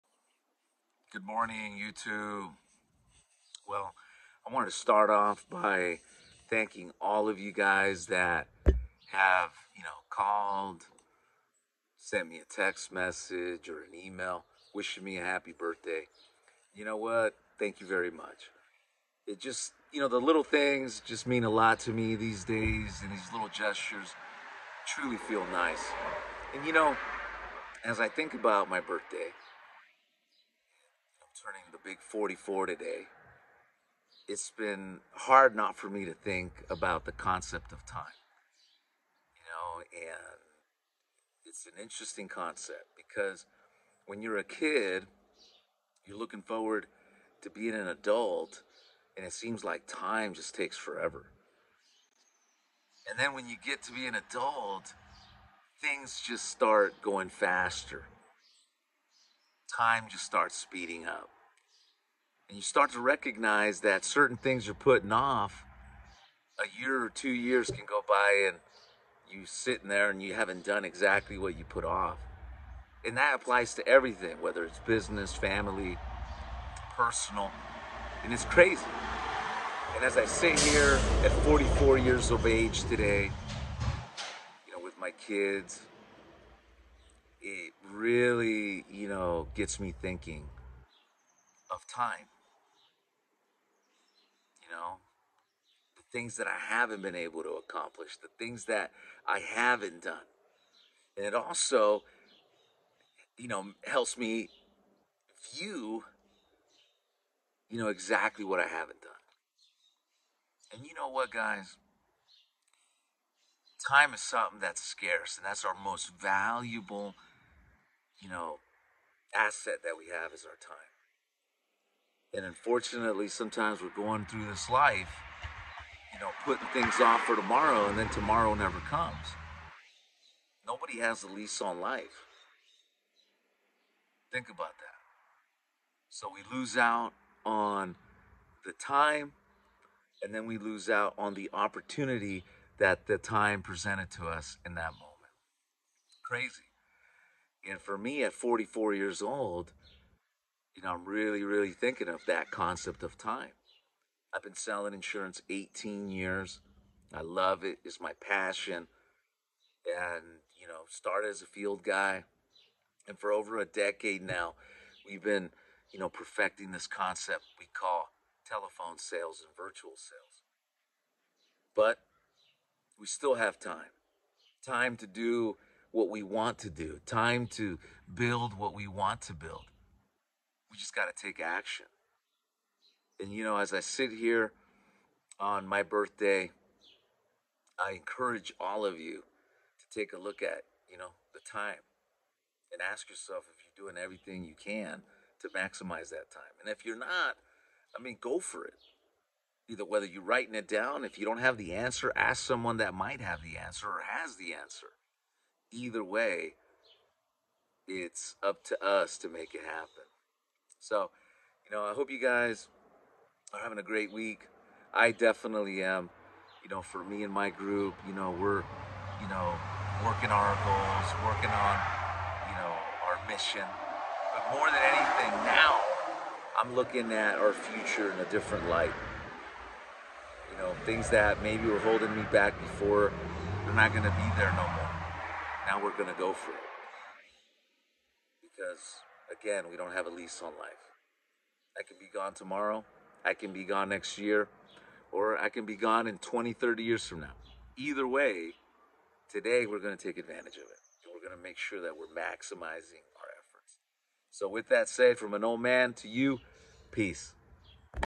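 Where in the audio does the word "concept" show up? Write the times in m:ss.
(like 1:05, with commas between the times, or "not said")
0:37, 0:42, 2:32, 2:46.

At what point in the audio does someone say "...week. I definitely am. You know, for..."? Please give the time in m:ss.
3:34.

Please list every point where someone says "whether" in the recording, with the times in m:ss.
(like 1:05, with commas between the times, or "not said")
1:14, 3:19.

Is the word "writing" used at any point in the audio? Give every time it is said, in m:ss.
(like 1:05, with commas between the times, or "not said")
3:20.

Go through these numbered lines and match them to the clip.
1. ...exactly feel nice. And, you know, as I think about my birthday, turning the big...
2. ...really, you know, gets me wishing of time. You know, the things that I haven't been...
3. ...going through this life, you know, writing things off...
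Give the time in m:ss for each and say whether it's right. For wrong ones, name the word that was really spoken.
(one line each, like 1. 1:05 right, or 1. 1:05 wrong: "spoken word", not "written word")
1. 0:24 wrong: "truly", not "exactly"
2. 1:27 wrong: "thinking", not "wishing"
3. 2:03 wrong: "putting", not "writing".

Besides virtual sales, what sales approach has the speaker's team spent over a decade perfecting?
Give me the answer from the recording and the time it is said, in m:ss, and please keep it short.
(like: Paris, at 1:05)
telephone sales, at 2:48.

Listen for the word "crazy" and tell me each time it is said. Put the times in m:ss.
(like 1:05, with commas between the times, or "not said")
1:18, 2:26.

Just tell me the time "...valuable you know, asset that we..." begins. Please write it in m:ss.
1:56.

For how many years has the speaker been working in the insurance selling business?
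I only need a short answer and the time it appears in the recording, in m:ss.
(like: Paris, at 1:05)
18, at 2:35.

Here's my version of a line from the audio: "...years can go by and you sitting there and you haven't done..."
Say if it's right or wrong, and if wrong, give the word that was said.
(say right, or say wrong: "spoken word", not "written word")
right.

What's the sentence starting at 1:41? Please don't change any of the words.
And it also, you know, helps me view, you know, exactly what I haven't done.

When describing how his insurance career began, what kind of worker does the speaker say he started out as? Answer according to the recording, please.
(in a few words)
field guy.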